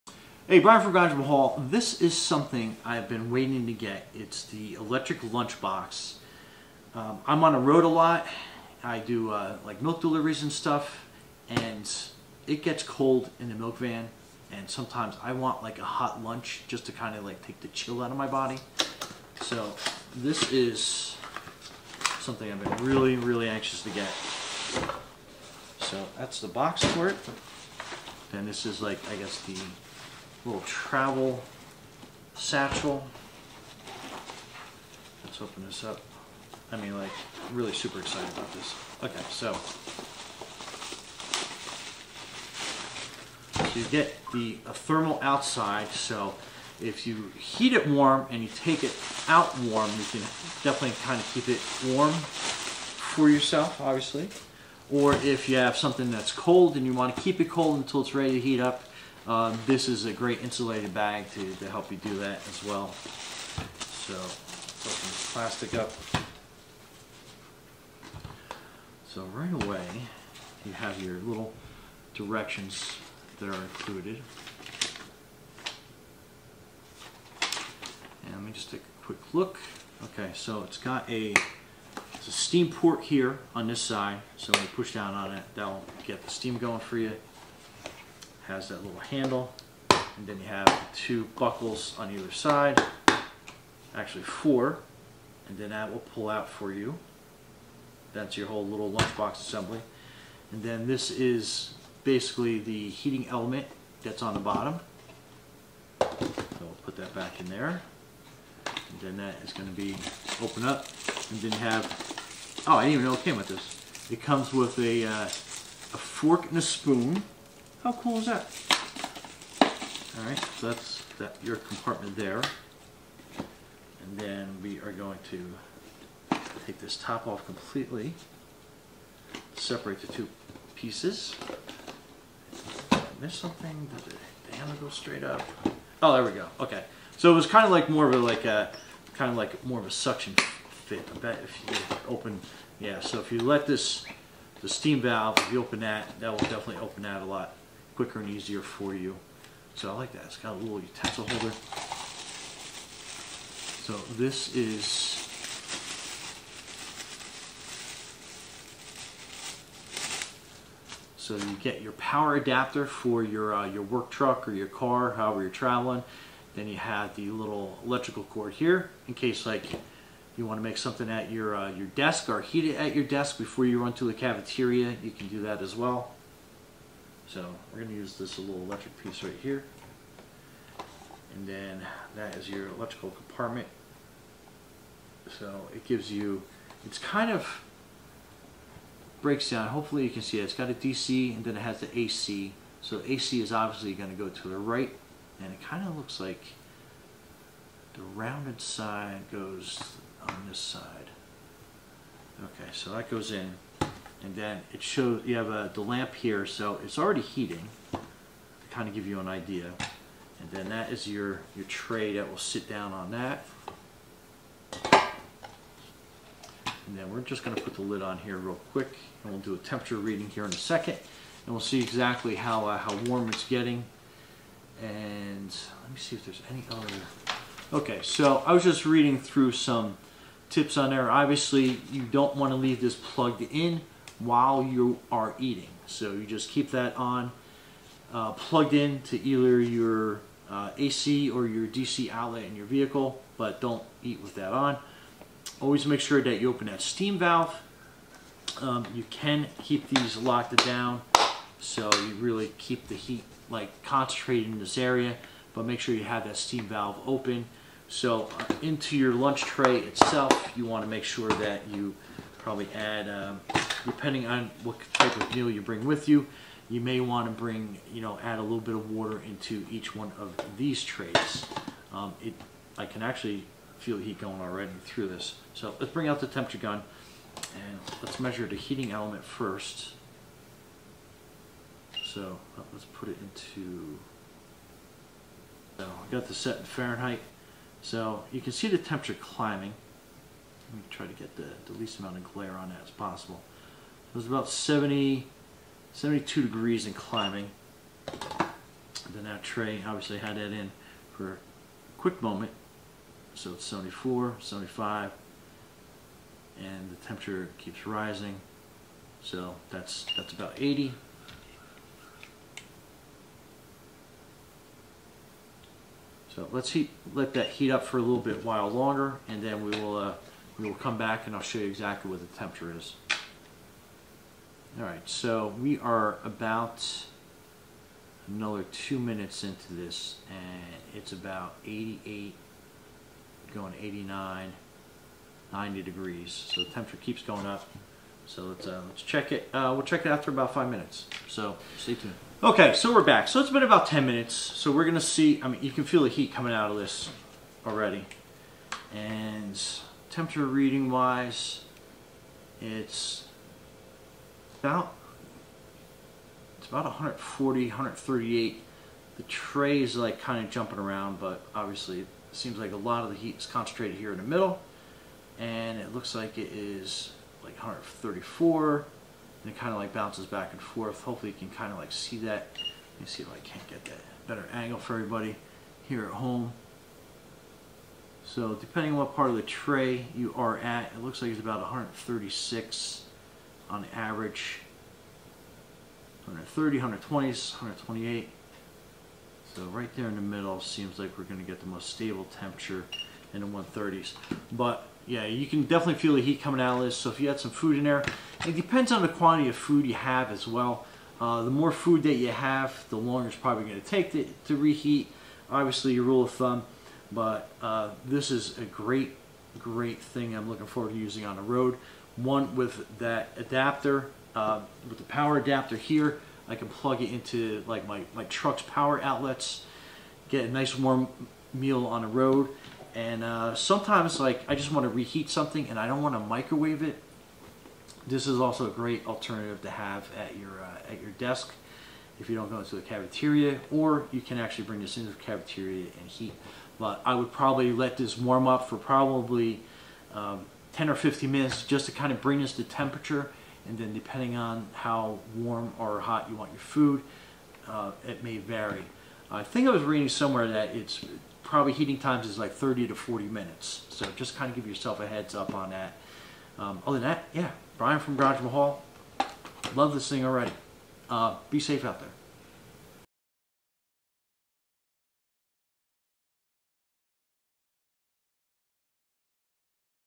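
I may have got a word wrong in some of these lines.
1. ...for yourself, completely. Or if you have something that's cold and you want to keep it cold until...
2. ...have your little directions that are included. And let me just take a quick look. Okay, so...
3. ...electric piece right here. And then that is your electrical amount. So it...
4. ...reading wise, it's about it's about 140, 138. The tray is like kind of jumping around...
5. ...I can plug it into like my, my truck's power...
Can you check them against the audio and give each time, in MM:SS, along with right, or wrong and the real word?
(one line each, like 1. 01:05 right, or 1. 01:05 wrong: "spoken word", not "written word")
1. 00:52 wrong: "obviously", not "completely"
2. 01:10 right
3. 02:58 wrong: "compartment", not "amount"
4. 05:50 right
5. 06:56 right.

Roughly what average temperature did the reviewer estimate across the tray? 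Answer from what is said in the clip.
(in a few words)
136.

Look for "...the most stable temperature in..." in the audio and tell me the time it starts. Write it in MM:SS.
06:31.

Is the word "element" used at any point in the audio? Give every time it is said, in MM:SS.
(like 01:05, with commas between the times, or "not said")
01:43, 04:38.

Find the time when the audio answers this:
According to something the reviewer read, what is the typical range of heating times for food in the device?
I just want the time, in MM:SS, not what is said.
07:32.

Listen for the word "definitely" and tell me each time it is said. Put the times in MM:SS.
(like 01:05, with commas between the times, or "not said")
00:50, 02:26, 06:35.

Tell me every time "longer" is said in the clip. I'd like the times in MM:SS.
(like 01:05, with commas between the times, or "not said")
05:18, 06:42.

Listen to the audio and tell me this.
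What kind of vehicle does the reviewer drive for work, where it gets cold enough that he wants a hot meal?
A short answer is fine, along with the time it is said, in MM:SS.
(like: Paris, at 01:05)
Milk van, at 00:13.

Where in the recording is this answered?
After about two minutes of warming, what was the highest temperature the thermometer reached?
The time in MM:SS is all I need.
05:35.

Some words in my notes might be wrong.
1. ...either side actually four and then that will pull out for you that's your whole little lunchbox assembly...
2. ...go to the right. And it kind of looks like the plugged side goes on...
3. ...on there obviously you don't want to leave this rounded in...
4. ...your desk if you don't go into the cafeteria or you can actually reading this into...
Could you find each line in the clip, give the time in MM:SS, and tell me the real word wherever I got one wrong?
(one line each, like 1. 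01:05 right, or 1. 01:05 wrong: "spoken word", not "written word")
1. 01:32 right
2. 03:14 wrong: "rounded", not "plugged"
3. 03:50 wrong: "plugged", not "rounded"
4. 07:11 wrong: "bring", not "reading".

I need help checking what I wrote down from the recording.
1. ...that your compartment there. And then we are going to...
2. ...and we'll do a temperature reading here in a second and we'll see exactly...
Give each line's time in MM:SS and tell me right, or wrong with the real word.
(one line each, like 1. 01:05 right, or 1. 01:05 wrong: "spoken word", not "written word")
1. 02:01 right
2. 03:39 right.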